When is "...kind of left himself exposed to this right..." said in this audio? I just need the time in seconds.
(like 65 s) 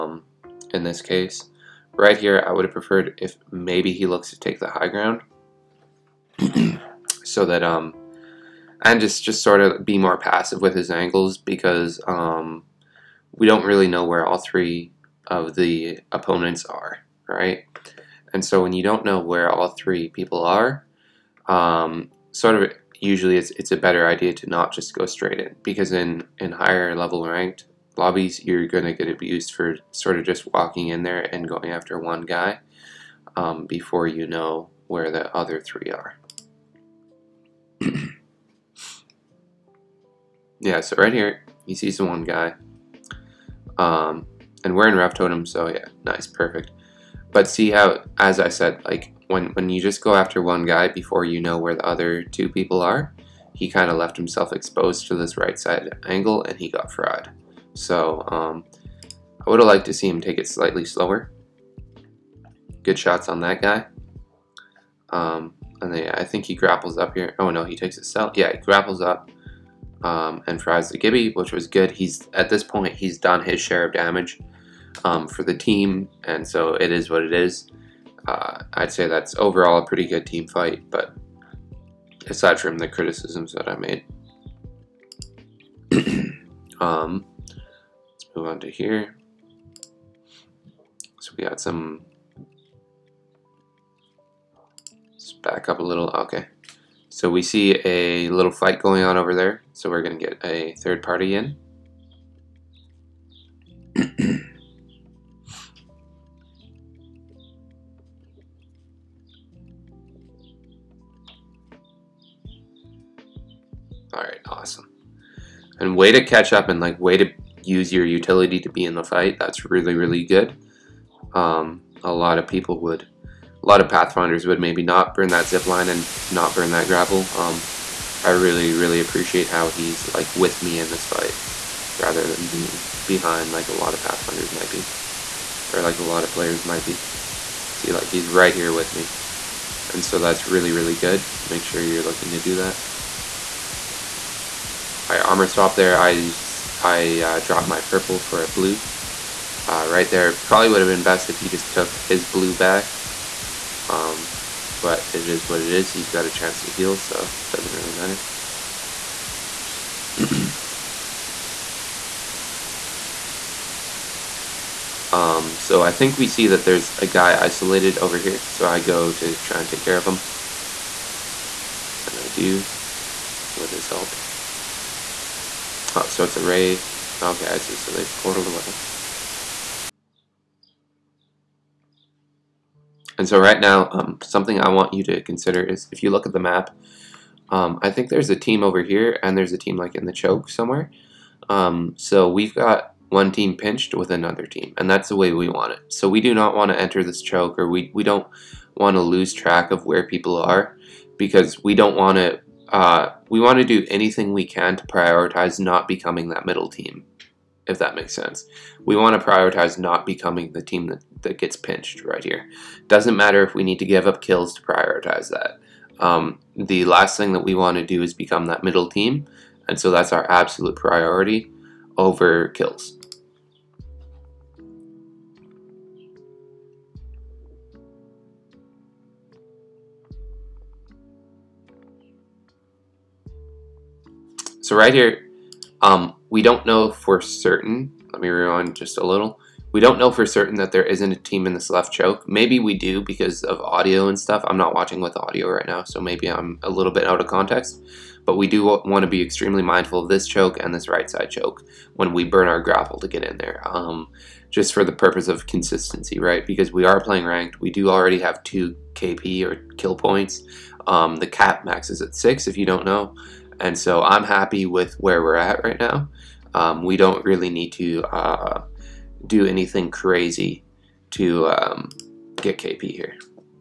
53 s.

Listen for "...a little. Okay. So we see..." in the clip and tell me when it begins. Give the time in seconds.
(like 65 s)
95 s.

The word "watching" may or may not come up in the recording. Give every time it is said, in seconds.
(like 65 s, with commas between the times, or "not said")
244 s.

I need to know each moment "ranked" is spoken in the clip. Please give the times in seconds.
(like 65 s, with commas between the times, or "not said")
27 s, 257 s.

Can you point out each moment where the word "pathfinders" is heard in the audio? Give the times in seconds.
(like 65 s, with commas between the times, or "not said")
123 s, 133 s.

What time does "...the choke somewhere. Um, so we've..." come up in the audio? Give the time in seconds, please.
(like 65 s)
190 s.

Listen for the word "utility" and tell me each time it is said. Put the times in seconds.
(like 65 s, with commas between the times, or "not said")
118 s.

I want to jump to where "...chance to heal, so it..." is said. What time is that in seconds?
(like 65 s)
156 s.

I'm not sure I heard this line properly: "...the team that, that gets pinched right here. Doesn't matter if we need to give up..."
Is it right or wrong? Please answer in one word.
right.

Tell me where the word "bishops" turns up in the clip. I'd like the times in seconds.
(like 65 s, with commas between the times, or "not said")
not said.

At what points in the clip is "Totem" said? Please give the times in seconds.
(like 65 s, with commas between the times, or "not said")
45 s.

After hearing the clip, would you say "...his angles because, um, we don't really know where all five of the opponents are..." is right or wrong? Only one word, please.
wrong.